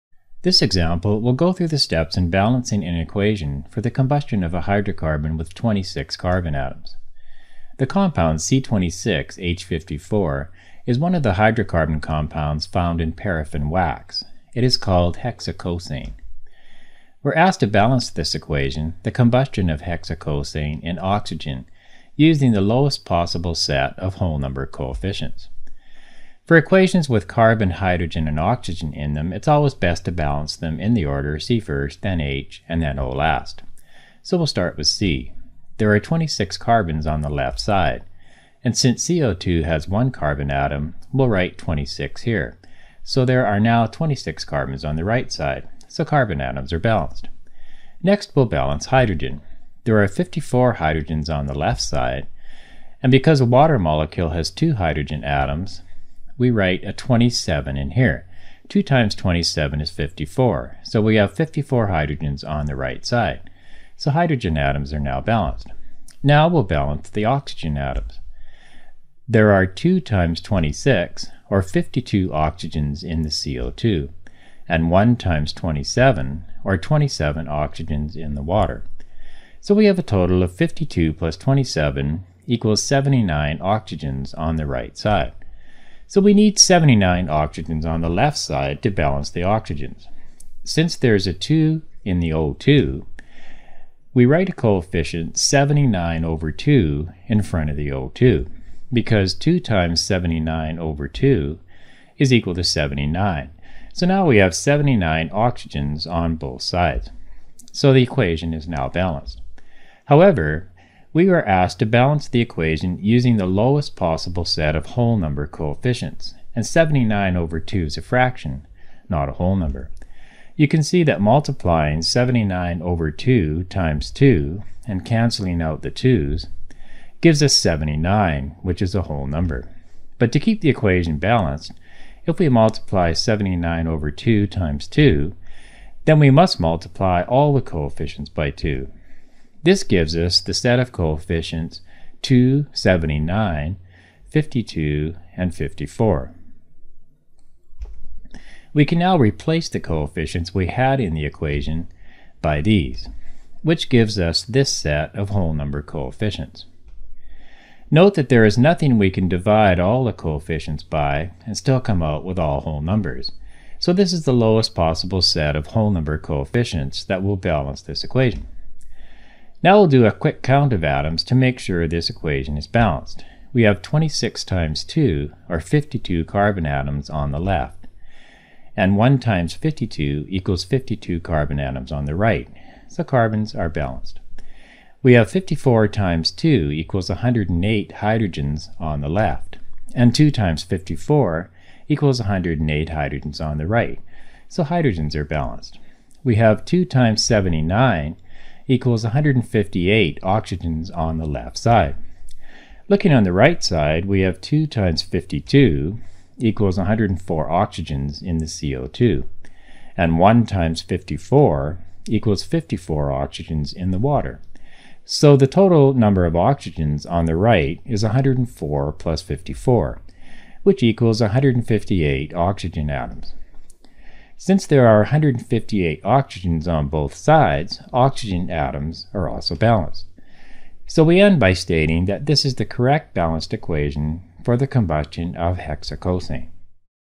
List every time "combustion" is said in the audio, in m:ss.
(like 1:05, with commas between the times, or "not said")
0:03, 0:19, 3:54.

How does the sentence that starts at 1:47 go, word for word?
So the equation is now balanced.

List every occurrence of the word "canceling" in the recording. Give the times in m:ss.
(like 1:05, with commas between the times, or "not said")
2:05.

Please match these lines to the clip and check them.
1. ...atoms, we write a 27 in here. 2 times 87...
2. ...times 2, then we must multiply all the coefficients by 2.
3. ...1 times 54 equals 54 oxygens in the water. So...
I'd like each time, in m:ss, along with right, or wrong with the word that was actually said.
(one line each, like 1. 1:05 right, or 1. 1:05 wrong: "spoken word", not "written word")
1. 0:55 wrong: "27", not "87"
2. 2:14 right
3. 3:30 right.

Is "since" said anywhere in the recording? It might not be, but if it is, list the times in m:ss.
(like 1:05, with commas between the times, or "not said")
0:38, 1:30, 3:44.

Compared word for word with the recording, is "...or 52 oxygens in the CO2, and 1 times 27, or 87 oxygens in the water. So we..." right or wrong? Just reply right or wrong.
wrong.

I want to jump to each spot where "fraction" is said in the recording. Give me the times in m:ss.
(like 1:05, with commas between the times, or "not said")
1:58.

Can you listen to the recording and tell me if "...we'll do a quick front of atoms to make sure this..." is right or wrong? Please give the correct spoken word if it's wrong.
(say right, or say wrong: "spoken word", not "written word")
wrong: "count", not "front".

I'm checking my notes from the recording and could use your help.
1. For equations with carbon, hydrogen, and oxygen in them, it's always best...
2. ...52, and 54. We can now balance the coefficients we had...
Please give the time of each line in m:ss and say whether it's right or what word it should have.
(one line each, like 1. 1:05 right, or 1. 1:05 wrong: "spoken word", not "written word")
1. 0:26 right
2. 2:24 wrong: "replace", not "balance".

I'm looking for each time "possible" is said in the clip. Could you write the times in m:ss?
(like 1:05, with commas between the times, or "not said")
0:23, 1:53, 2:44.